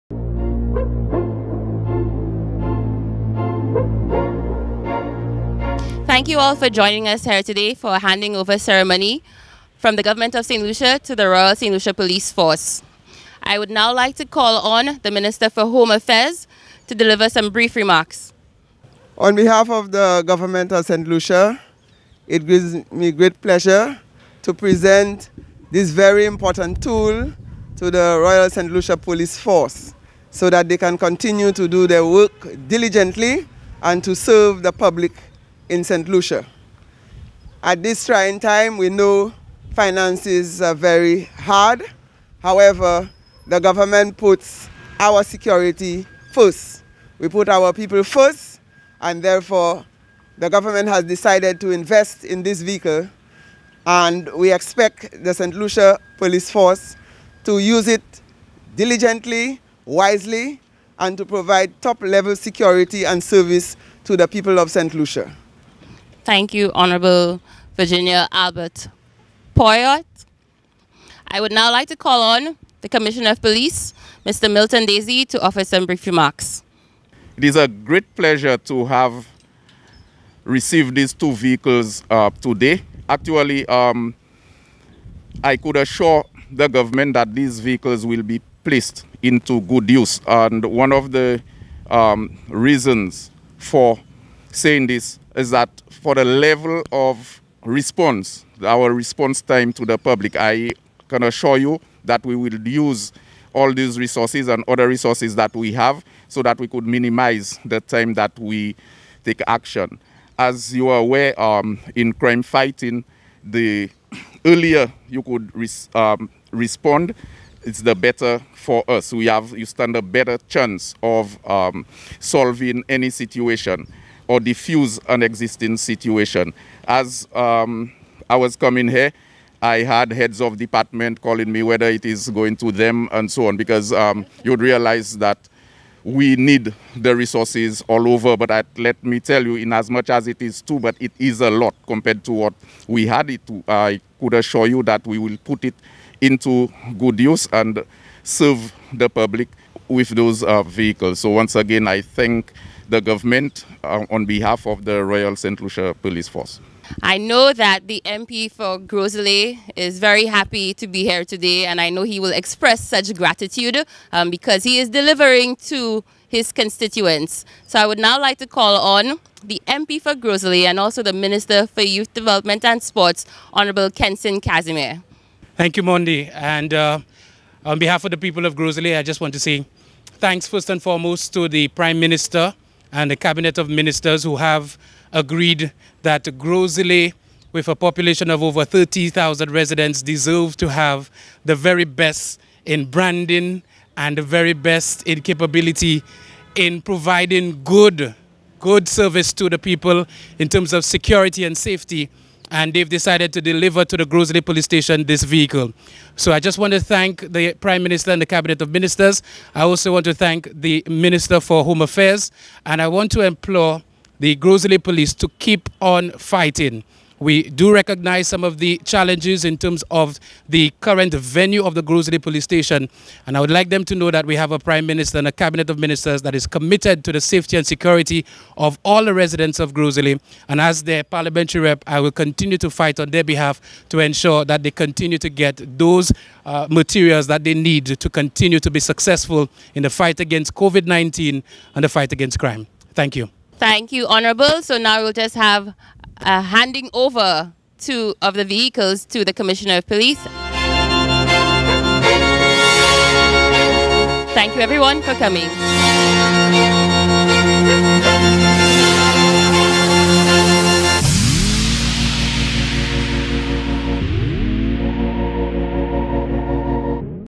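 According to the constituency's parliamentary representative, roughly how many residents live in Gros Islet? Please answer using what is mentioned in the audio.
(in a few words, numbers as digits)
over 30,000.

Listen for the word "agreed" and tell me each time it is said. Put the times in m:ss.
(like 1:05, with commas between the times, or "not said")
3:05.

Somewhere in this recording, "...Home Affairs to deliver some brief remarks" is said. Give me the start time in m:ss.
0:15.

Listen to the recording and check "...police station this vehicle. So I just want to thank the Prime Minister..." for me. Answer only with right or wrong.
right.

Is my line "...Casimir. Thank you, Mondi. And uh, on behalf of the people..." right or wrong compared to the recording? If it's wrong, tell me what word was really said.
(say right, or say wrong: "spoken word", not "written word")
right.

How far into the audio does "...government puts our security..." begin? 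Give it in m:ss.
0:43.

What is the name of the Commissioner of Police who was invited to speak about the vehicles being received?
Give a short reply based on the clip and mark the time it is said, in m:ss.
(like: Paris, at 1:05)
Milton Desir, at 1:14.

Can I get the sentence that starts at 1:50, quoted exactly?
As you are aware, um, in crime fighting, the earlier you could res um, respond, it's the better for us.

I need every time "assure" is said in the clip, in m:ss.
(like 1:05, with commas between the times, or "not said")
1:25, 1:41, 2:24.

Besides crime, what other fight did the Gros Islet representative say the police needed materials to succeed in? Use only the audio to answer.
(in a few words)
COVID-19.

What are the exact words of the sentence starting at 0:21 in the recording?
Lucia, it gives me great pleasure to present this very important tool to the Royal St.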